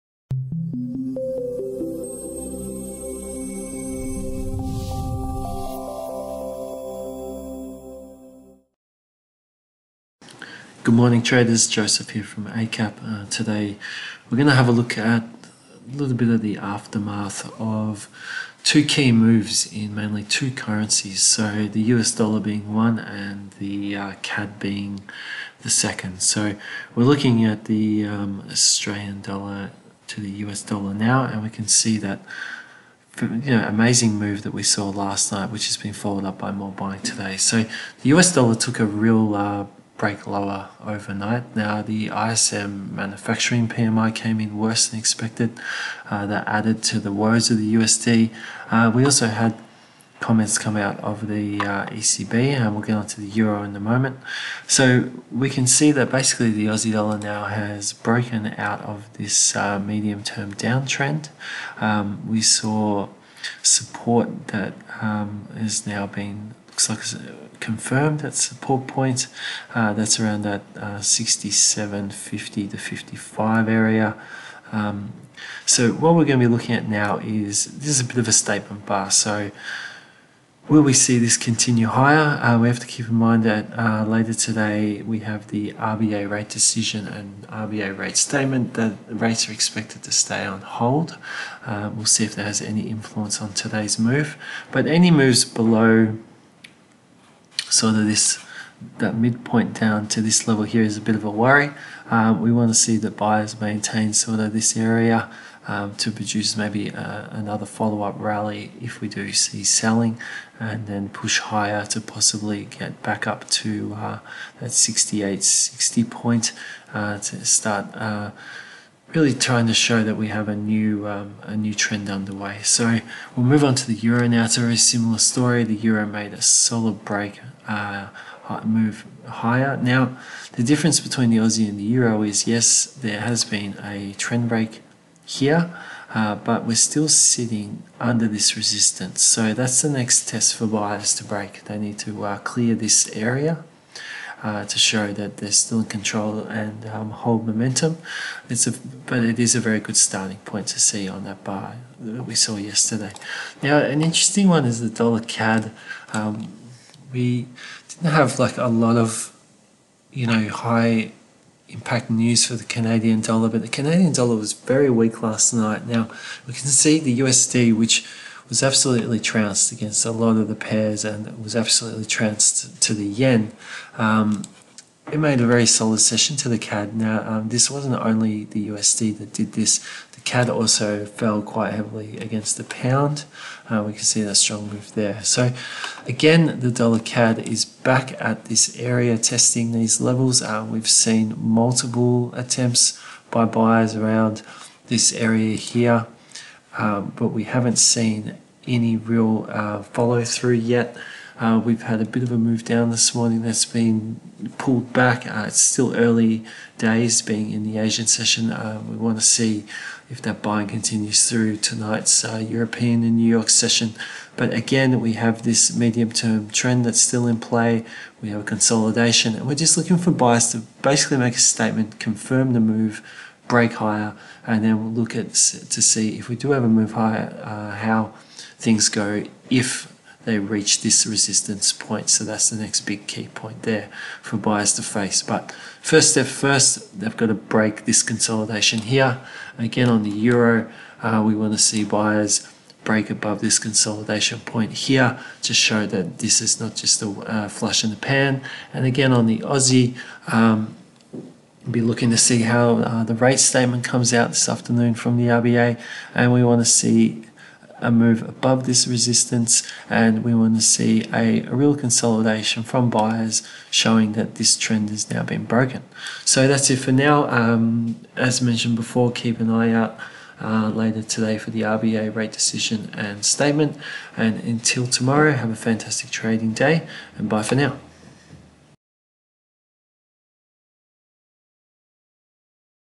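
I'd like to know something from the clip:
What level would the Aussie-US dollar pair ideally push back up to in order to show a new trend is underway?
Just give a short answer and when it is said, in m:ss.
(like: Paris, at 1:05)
68 60, at 1:54.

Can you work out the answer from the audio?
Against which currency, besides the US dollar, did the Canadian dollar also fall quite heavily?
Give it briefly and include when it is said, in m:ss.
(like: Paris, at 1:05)
the pound, at 3:02.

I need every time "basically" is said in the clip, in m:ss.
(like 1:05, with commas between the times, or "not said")
0:56, 3:40.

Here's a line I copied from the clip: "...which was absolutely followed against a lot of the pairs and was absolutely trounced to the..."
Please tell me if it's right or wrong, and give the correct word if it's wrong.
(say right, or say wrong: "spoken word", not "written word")
wrong: "trounced", not "followed".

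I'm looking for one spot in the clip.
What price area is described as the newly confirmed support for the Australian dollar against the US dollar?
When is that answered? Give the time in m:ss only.
1:10.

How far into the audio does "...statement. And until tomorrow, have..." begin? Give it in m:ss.
4:33.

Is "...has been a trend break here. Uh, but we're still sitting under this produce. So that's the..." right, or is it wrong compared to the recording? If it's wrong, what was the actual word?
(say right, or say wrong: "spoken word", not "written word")
wrong: "resistance", not "produce".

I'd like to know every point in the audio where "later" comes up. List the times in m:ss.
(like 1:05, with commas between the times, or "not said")
1:24, 4:30.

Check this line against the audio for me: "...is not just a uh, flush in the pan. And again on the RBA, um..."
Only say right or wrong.
wrong.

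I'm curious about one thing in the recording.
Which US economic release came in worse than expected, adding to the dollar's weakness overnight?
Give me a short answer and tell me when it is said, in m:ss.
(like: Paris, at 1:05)
ISM manufacturing PMI, at 0:42.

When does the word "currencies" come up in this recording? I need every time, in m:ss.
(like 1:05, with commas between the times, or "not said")
0:20.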